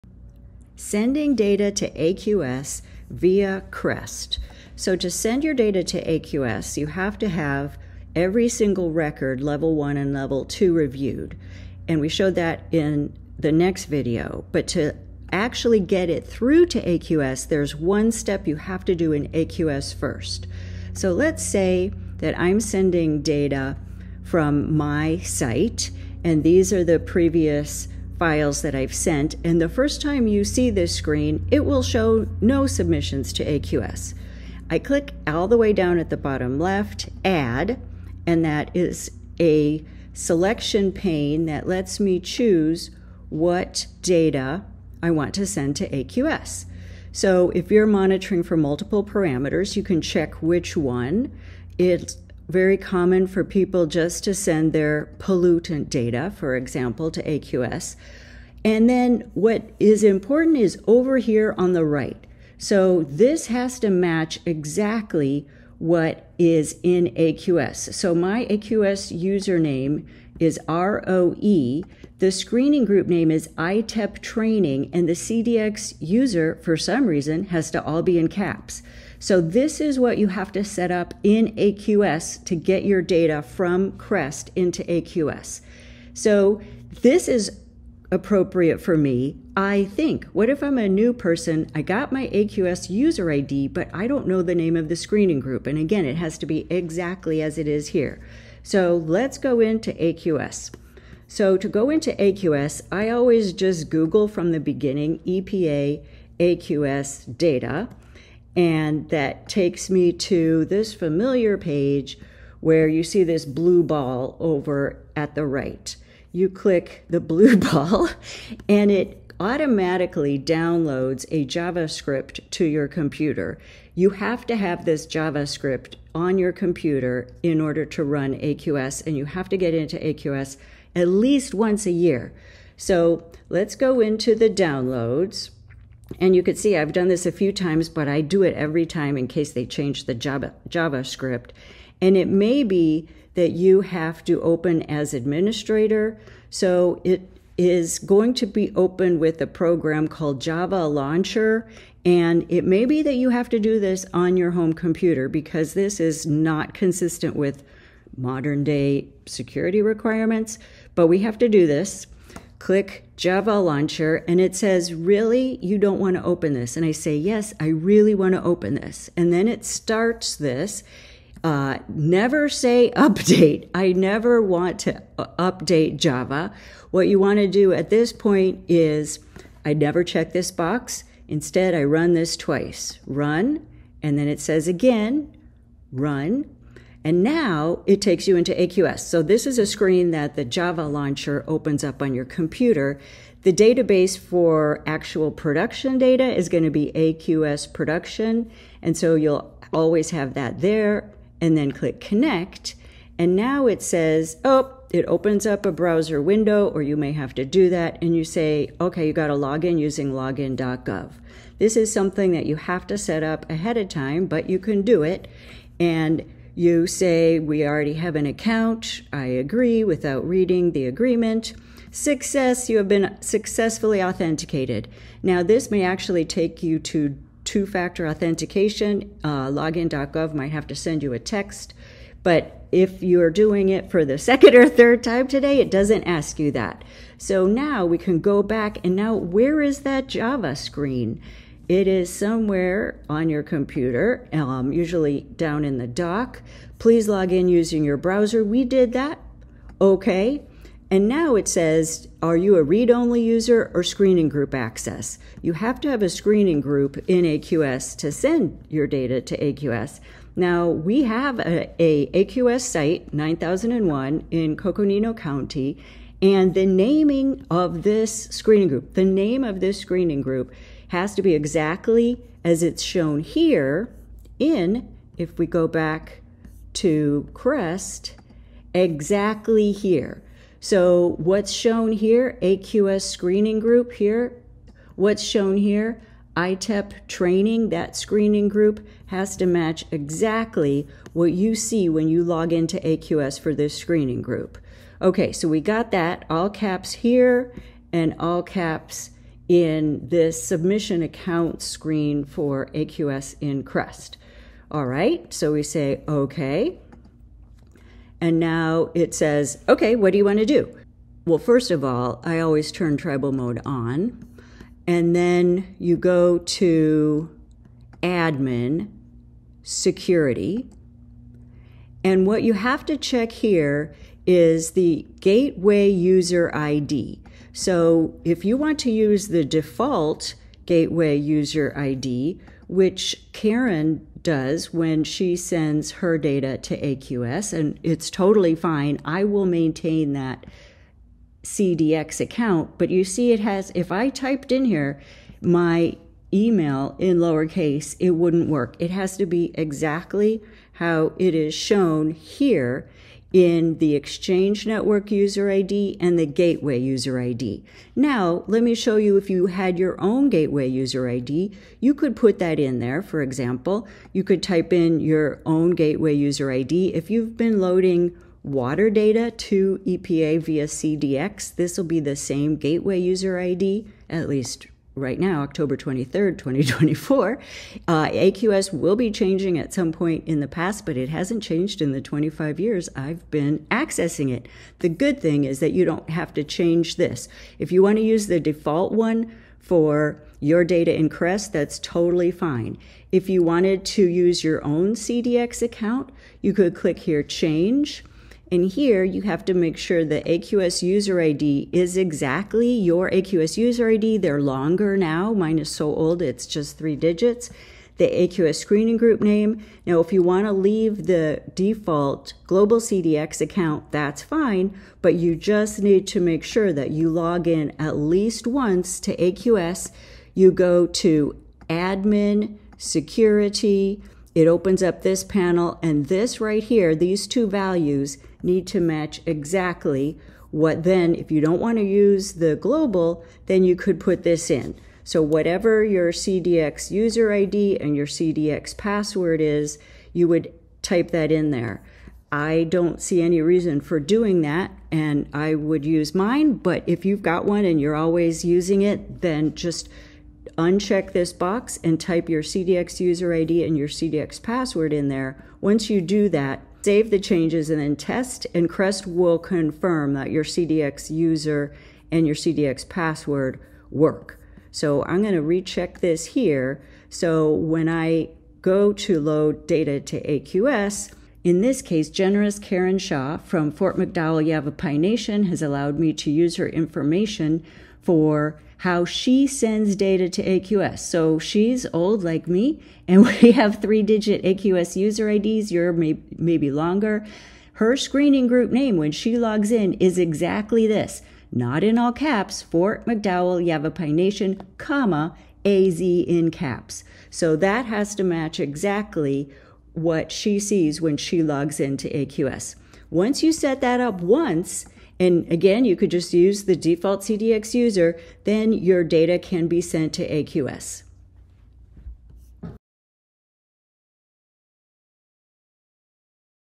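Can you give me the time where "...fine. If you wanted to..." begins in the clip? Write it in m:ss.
6:32.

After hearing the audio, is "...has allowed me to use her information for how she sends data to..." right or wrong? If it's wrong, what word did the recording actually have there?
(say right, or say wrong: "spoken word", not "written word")
right.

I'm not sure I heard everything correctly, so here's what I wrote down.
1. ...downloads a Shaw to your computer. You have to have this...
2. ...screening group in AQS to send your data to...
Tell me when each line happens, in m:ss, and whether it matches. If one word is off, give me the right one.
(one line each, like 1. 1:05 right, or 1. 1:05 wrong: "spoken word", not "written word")
1. 2:00 wrong: "JavaScript", not "Shaw"
2. 4:16 right.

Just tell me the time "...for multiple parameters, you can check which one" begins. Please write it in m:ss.
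0:48.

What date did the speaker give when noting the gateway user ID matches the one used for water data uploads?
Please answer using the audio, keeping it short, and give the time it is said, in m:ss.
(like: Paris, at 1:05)
October 23rd, 2024, at 6:15.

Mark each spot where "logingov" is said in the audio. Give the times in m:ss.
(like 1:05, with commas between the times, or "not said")
3:30, 3:49.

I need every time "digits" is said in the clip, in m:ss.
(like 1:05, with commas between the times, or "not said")
6:46, 8:04.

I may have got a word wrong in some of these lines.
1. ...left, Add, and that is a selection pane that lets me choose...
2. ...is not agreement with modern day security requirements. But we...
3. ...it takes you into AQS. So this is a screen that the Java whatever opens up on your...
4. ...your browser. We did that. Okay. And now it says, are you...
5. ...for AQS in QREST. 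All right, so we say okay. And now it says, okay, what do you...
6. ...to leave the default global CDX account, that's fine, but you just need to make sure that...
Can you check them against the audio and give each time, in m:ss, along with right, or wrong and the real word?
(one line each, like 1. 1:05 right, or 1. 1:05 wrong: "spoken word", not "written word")
1. 0:36 right
2. 2:35 wrong: "consistent", not "agreement"
3. 3:07 wrong: "launcher", not "whatever"
4. 4:07 right
5. 5:02 right
6. 6:50 right.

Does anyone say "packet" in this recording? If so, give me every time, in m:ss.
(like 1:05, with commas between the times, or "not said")
not said.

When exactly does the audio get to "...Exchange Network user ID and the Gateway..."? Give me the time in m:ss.
5:53.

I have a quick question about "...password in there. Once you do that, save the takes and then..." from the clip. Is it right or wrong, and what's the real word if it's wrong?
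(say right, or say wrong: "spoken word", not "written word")
wrong: "changes", not "takes".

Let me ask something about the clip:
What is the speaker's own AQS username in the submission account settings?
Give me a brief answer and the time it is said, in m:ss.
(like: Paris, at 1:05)
ROE, at 1:10.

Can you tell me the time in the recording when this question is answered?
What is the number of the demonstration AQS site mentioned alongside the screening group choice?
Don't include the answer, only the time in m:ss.
4:23.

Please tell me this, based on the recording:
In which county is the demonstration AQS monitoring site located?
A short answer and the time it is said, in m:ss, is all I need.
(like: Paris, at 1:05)
Coconino County, at 4:24.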